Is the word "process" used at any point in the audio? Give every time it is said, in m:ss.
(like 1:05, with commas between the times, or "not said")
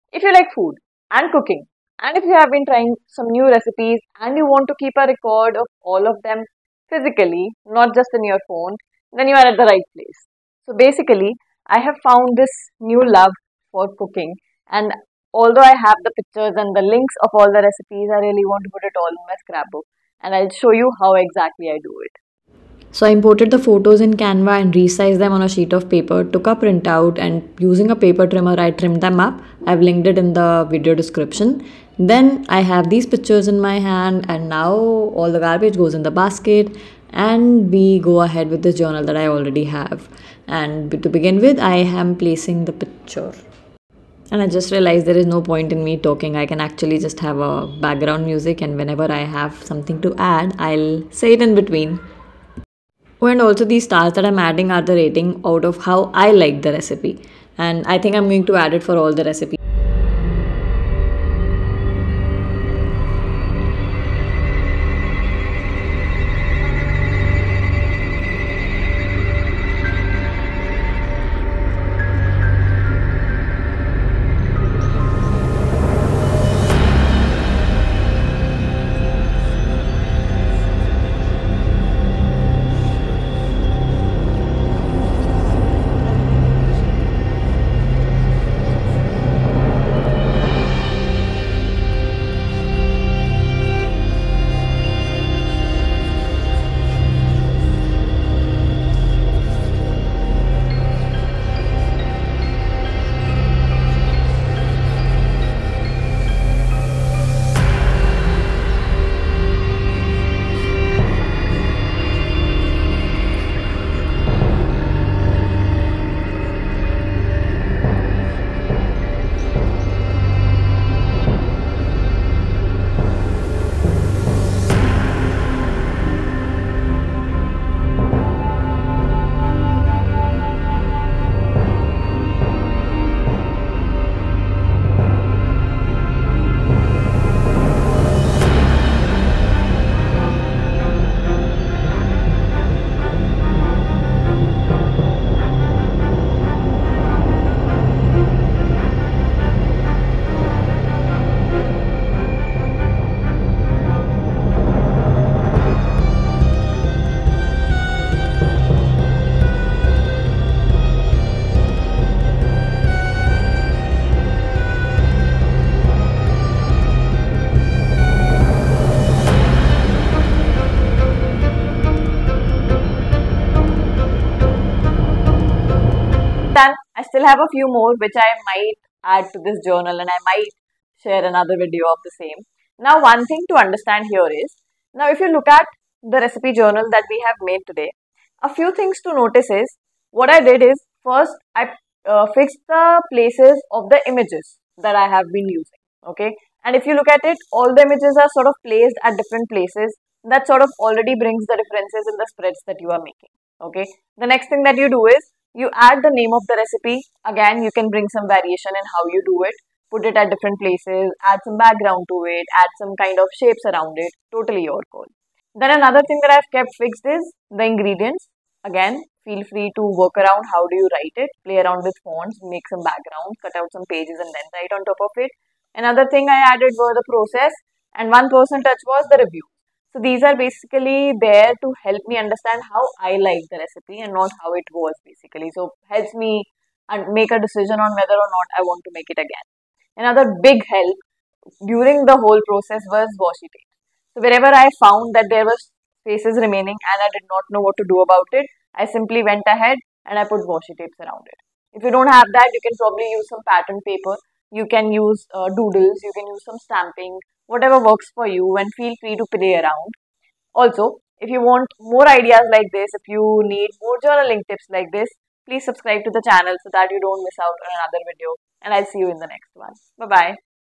3:47, 4:02.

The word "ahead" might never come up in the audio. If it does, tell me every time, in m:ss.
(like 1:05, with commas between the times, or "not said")
0:38, 4:09.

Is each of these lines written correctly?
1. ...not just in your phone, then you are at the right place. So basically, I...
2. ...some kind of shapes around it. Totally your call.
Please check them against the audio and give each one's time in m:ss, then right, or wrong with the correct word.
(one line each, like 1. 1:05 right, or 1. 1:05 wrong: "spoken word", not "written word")
1. 0:07 right
2. 3:32 right.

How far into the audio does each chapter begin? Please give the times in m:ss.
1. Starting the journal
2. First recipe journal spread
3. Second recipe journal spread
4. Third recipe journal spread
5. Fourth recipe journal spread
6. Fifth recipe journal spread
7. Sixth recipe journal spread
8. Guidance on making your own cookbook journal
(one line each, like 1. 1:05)
1. 0:22
2. 0:40
3. 0:58
4. 1:15
5. 1:44
6. 2:10
7. 2:33
8. 2:56.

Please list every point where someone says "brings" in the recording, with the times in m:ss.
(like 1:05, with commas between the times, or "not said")
3:21, 3:27.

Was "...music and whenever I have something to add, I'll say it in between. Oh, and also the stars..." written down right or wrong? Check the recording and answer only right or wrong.
right.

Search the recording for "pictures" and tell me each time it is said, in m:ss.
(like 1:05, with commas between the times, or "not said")
0:16, 0:33, 0:42.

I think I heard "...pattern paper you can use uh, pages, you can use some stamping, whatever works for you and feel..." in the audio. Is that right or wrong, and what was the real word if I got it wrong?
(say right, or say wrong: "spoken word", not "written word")
wrong: "doodles", not "pages".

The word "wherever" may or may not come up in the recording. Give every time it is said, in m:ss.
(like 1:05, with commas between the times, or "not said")
4:04.